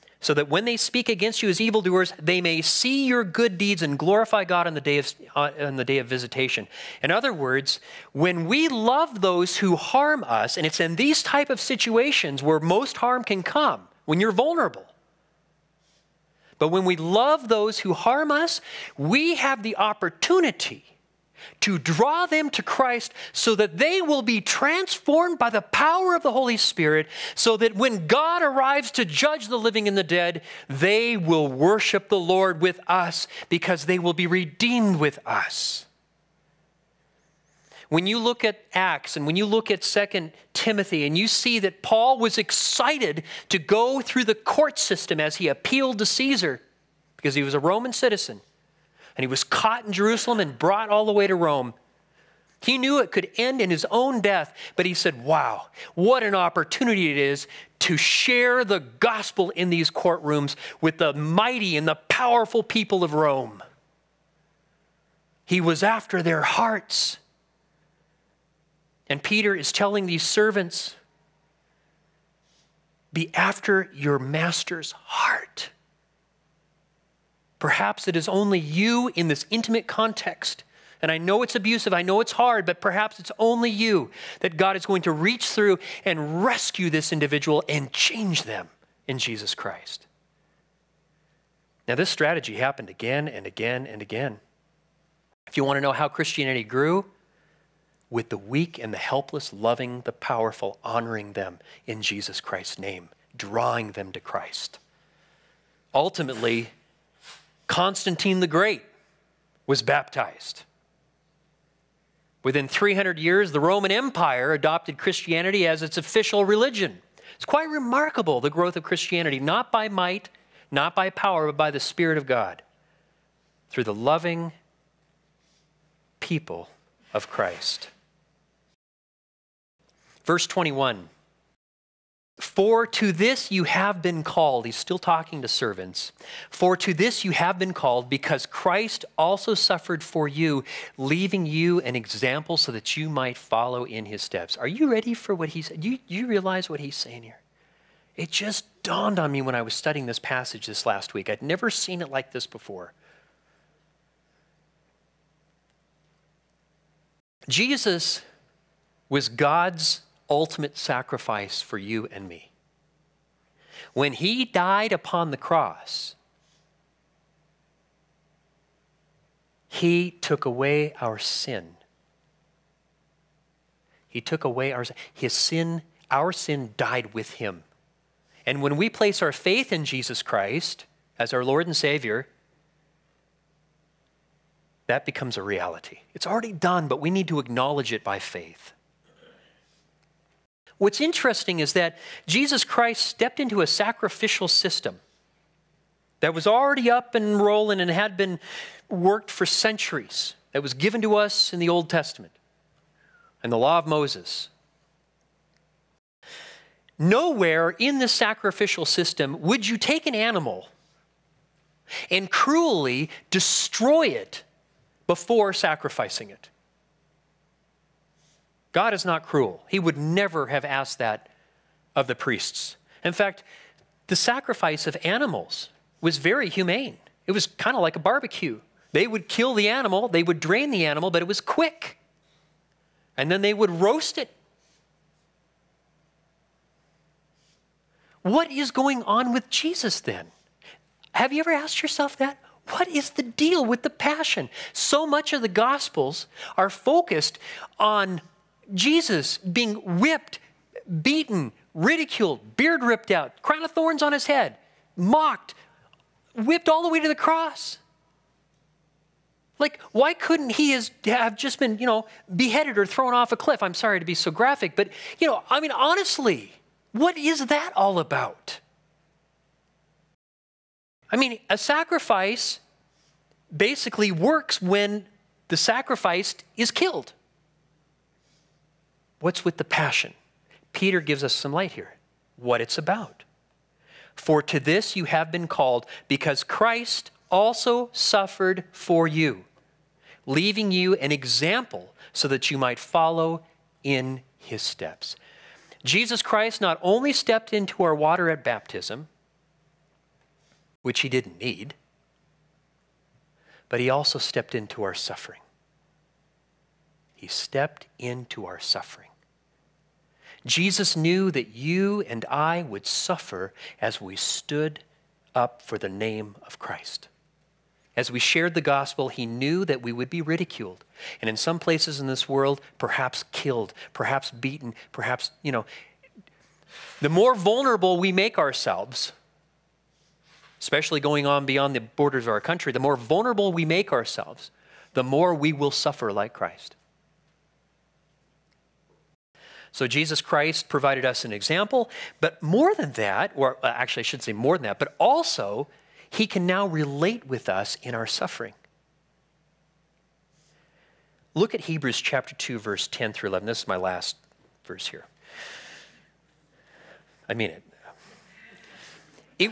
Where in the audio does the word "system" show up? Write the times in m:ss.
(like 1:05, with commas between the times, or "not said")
0:44, 3:14, 3:28.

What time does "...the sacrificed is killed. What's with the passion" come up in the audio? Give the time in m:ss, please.
4:35.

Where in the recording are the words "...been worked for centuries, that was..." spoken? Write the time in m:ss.
3:18.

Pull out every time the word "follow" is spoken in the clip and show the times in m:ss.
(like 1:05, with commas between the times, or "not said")
2:23, 4:52.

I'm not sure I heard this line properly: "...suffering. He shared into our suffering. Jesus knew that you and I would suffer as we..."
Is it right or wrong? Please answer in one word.
wrong.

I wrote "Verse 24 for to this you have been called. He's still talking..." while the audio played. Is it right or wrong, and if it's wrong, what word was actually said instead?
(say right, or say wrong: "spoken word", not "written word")
wrong: "21", not "24".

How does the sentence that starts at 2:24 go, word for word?
Are you ready for what he said?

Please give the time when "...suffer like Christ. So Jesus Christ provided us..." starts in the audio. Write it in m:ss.
5:35.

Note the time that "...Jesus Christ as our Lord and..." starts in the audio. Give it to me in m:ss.
2:59.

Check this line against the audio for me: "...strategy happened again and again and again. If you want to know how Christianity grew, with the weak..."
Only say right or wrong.
right.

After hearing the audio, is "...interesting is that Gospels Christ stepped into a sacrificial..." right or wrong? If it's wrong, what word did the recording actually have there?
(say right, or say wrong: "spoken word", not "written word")
wrong: "Jesus", not "Gospels".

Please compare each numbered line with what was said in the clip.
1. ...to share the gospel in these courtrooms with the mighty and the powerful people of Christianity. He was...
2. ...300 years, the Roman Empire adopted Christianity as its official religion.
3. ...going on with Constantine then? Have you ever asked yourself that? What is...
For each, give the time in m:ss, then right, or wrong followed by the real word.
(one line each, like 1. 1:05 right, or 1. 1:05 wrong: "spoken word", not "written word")
1. 0:57 wrong: "Rome", not "Christianity"
2. 1:52 right
3. 3:58 wrong: "Jesus", not "Constantine".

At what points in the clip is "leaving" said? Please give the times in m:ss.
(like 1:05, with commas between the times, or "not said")
2:20, 4:50.